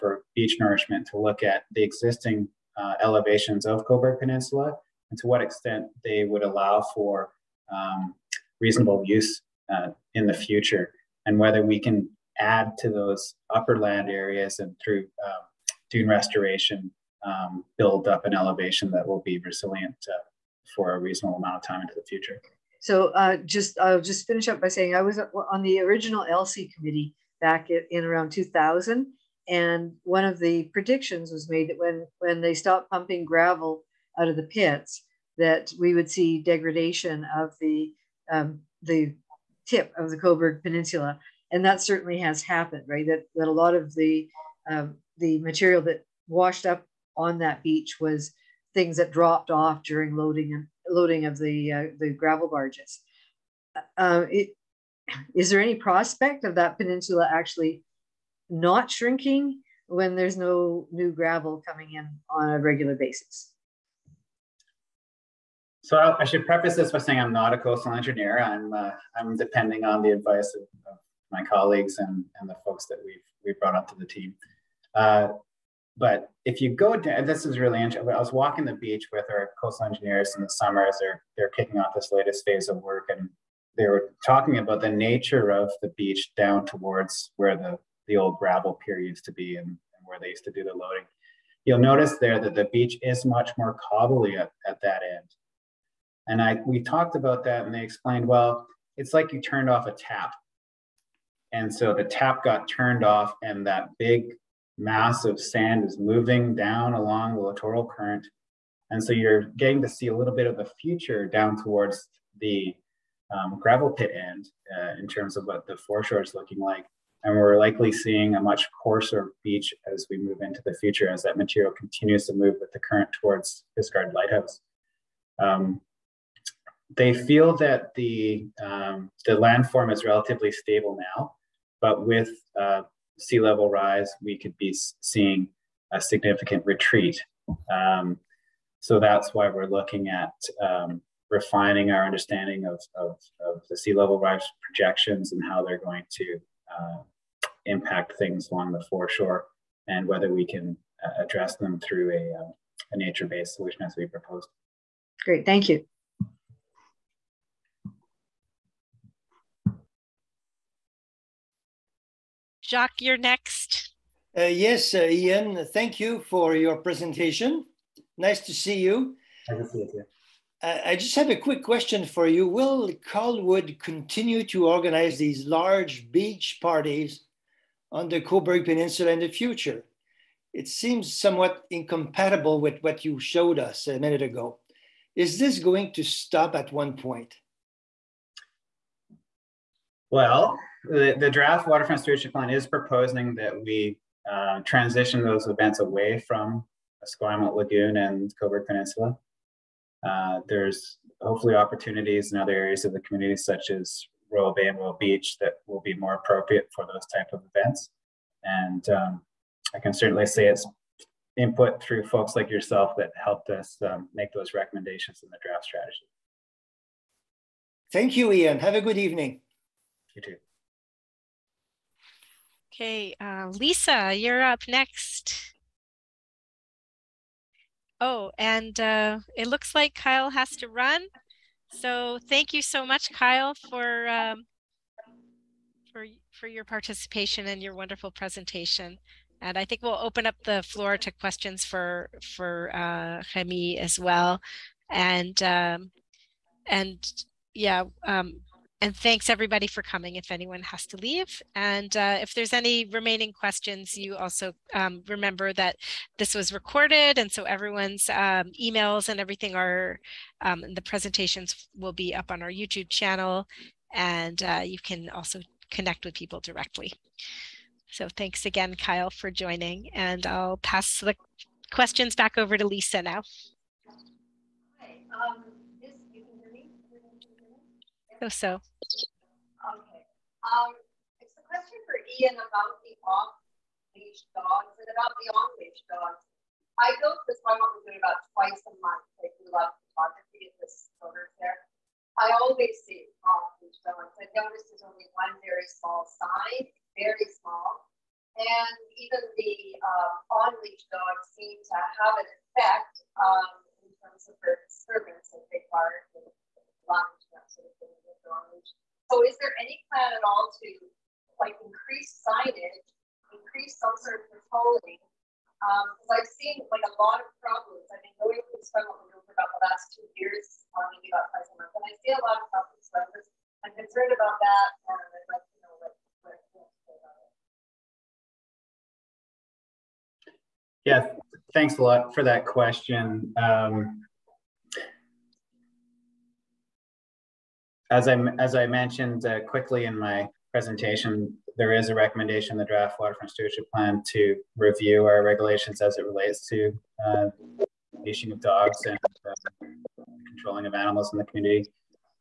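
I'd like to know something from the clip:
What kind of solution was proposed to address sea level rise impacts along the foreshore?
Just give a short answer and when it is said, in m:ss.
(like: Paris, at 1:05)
Nature-based solution, at 2:32.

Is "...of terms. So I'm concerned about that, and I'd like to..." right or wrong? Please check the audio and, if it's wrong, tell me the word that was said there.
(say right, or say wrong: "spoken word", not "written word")
wrong: "problems", not "terms".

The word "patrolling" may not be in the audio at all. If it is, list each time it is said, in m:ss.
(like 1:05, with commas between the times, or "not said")
5:14.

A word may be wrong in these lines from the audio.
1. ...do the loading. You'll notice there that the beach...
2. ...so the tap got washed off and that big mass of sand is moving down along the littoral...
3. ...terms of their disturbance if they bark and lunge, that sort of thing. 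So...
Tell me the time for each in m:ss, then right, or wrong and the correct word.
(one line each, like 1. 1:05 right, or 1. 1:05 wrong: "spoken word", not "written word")
1. 1:30 right
2. 1:41 wrong: "turned", not "washed"
3. 5:03 right.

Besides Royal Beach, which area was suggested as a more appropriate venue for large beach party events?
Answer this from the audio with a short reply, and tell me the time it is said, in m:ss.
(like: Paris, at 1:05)
Royal Bay, at 3:24.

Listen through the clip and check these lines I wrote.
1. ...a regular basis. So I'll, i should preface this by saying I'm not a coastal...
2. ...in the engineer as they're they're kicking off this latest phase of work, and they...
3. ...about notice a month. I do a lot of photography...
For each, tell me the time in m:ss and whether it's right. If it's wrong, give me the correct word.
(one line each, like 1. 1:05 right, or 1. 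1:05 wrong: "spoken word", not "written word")
1. 1:02 right
2. 1:20 wrong: "summer", not "engineer"
3. 4:47 wrong: "twice", not "notice".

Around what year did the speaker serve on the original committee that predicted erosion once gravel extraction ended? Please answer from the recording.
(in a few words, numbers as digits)
2000.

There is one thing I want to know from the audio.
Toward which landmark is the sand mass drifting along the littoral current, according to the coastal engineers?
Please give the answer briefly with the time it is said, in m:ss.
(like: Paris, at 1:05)
Fisgard Lighthouse, at 2:03.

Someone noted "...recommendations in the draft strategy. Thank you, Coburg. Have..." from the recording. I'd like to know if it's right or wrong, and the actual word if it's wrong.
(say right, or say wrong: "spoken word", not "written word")
wrong: "Iain", not "Coburg".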